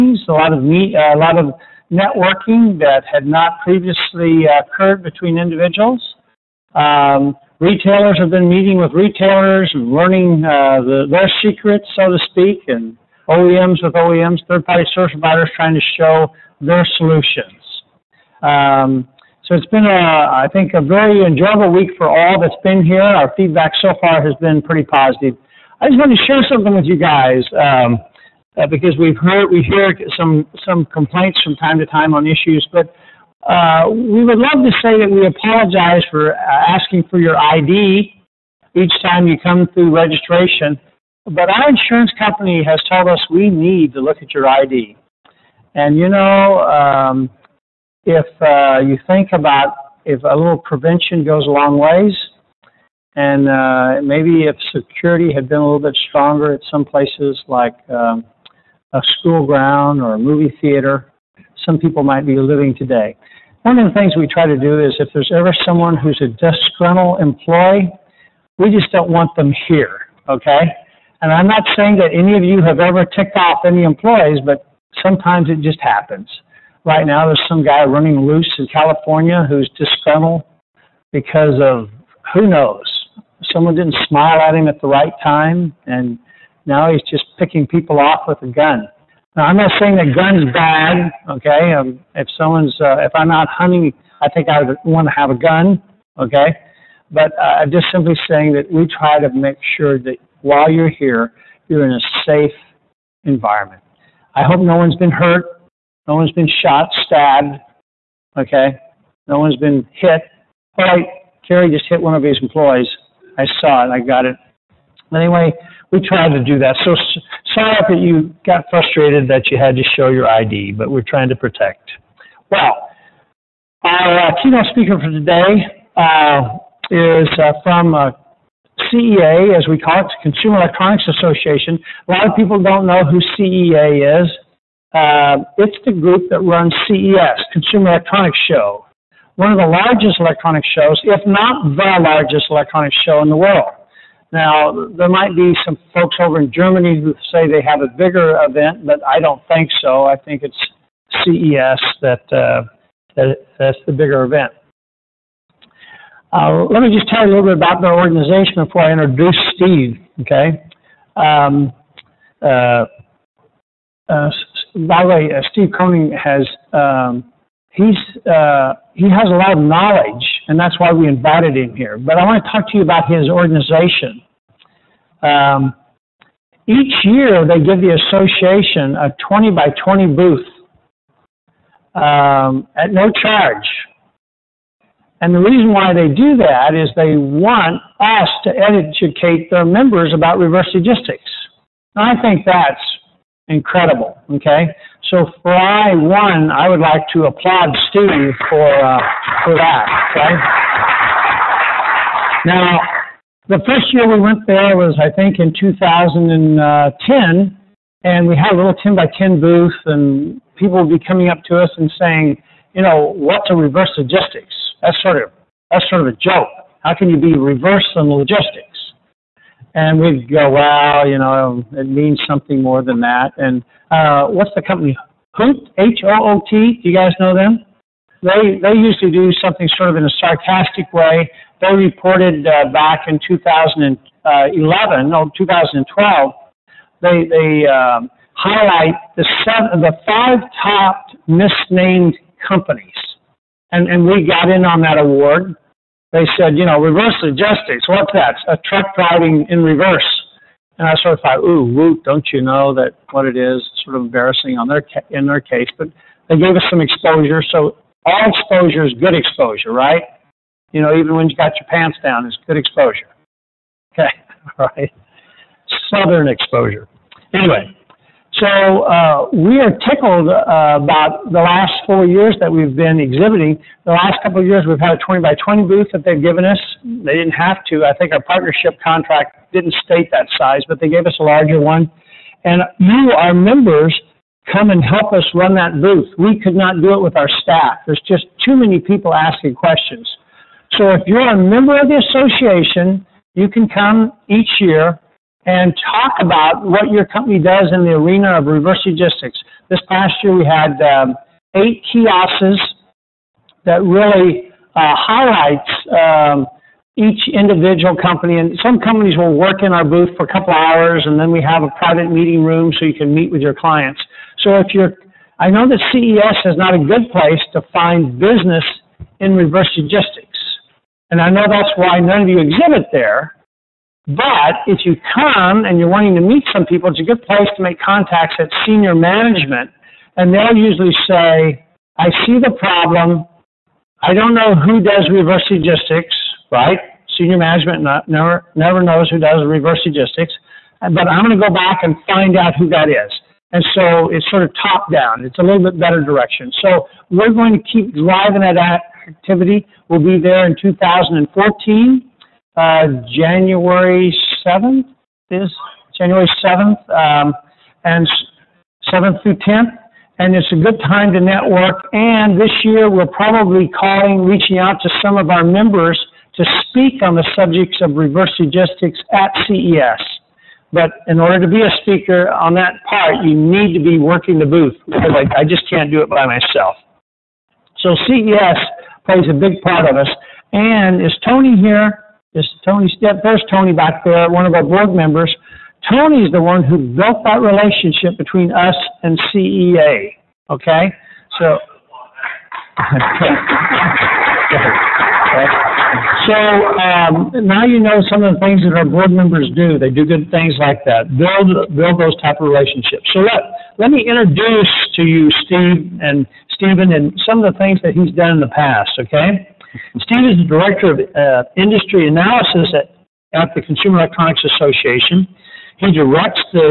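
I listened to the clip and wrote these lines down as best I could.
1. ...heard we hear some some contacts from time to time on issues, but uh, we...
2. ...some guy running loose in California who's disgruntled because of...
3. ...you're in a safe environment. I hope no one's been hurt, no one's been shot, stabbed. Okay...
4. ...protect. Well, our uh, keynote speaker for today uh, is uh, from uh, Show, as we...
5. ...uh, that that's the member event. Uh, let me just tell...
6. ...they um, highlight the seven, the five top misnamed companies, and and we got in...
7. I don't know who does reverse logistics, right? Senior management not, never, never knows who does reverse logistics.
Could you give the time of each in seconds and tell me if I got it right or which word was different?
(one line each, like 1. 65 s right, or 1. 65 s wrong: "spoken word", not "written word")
1. 29 s wrong: "complaints", not "contacts"
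2. 77 s right
3. 101 s right
4. 121 s wrong: "CEA", not "Show"
5. 152 s wrong: "bigger", not "member"
6. 237 s right
7. 334 s right.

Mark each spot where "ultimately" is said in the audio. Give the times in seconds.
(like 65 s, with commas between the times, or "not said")
not said.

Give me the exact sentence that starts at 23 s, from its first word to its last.
Our feedback so far has been pretty positive.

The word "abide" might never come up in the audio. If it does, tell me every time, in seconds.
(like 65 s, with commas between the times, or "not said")
not said.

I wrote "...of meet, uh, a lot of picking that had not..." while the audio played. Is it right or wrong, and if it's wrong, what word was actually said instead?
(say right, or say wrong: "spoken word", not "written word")
wrong: "networking", not "picking".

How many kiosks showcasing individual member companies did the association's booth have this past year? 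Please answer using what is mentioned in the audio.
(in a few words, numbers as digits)
8.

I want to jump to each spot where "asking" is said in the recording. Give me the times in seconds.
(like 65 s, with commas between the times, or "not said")
36 s, 289 s.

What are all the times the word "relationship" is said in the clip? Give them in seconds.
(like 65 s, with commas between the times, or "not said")
387 s, 402 s.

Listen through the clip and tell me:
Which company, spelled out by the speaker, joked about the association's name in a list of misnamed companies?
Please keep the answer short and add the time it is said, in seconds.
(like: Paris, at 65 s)
Hoot, at 225 s.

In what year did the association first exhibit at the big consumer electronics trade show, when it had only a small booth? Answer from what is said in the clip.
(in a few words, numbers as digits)
2010.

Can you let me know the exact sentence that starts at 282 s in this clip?
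And you, our members, come and help us run that booth.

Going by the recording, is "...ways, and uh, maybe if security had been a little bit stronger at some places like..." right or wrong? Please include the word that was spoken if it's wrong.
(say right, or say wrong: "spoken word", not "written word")
right.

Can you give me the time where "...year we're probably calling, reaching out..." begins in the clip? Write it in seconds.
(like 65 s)
362 s.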